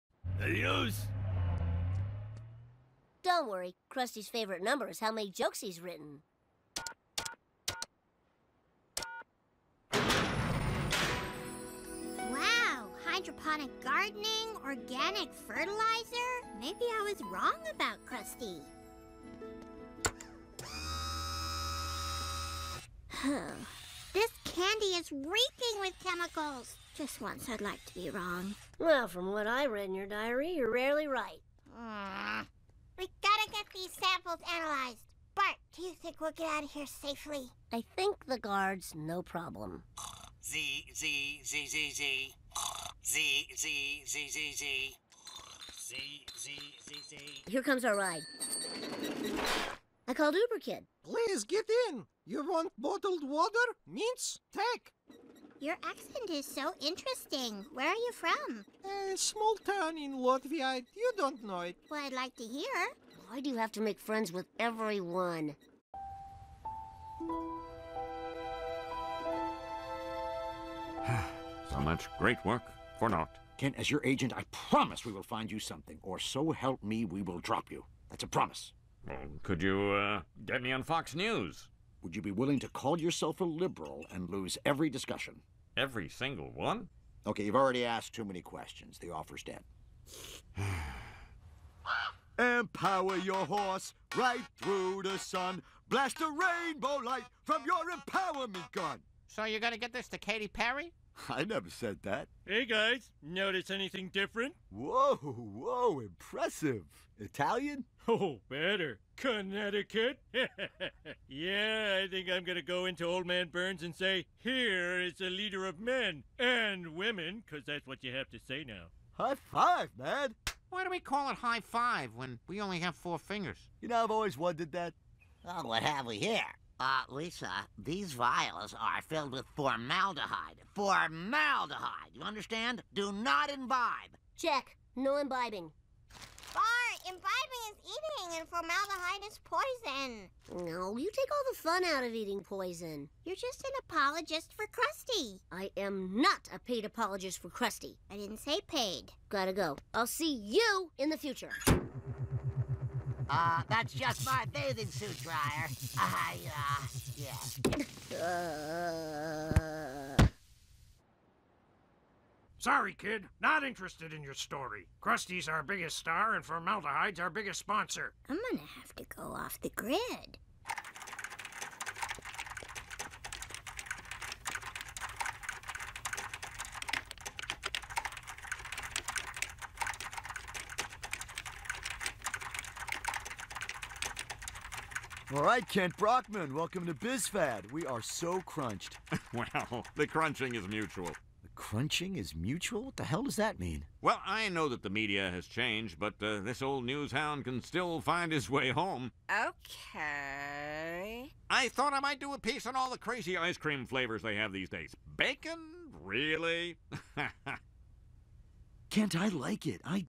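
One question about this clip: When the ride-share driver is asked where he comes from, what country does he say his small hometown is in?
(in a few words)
Latvia.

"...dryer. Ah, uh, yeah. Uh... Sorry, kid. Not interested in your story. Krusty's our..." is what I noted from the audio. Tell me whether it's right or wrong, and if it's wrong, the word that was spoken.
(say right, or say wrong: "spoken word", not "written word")
right.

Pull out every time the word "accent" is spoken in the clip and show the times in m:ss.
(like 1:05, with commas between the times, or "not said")
0:55.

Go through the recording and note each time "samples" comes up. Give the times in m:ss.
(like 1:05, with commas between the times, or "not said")
0:33.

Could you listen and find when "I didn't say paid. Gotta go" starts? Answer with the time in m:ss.
2:28.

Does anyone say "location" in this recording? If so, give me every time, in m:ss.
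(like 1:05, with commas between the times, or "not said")
not said.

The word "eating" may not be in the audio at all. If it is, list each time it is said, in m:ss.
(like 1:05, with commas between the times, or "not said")
2:17, 2:22.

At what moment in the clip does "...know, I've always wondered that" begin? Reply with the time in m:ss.
2:03.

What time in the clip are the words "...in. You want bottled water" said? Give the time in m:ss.
0:51.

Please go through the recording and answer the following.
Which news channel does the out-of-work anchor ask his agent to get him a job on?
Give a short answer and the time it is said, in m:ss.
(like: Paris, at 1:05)
Fox News, at 1:20.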